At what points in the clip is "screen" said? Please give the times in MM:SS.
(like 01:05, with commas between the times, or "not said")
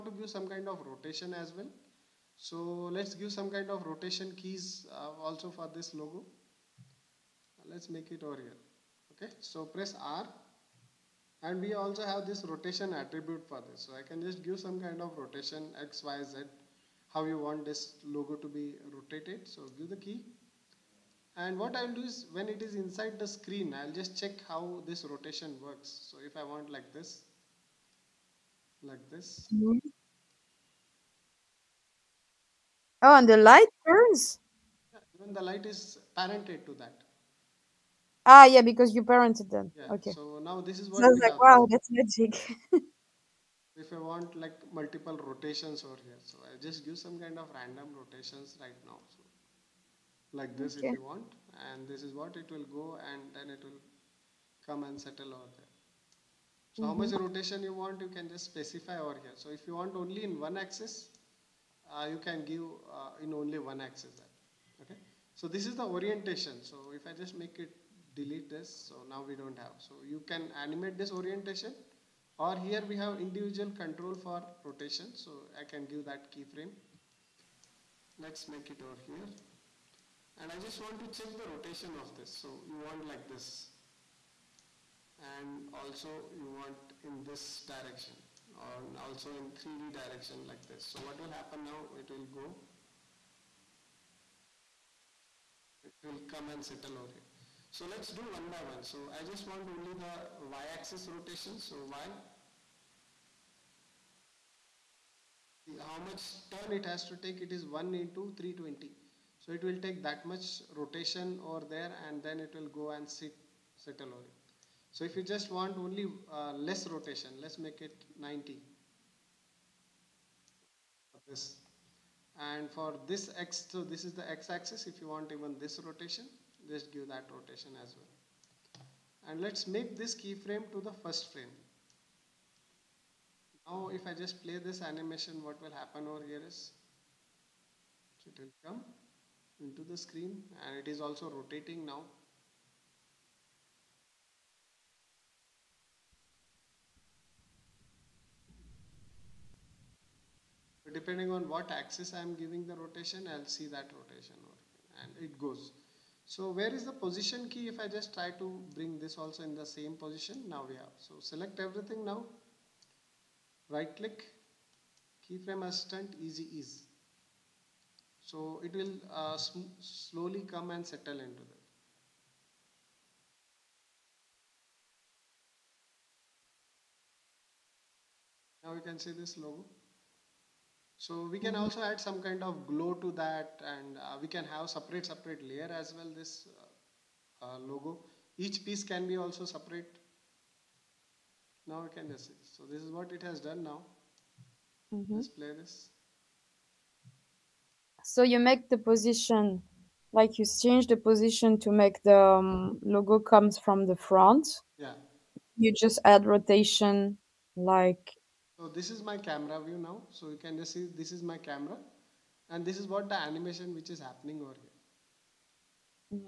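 00:23, 02:19.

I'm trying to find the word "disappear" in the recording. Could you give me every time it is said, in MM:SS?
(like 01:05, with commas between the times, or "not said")
not said.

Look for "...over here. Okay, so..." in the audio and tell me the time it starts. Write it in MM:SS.
00:08.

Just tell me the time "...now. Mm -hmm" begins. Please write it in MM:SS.
03:13.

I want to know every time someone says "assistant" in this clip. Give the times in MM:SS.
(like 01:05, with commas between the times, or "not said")
02:45.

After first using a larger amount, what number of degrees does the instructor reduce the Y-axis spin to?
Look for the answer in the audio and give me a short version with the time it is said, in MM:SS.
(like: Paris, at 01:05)
90, at 01:57.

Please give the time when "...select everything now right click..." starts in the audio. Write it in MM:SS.
02:41.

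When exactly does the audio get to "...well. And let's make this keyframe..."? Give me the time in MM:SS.
02:07.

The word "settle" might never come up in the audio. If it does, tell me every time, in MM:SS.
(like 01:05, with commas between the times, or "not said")
00:55, 01:36, 01:53, 02:50.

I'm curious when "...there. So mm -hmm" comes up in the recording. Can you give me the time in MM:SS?
00:55.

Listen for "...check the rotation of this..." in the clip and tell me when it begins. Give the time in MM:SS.
01:21.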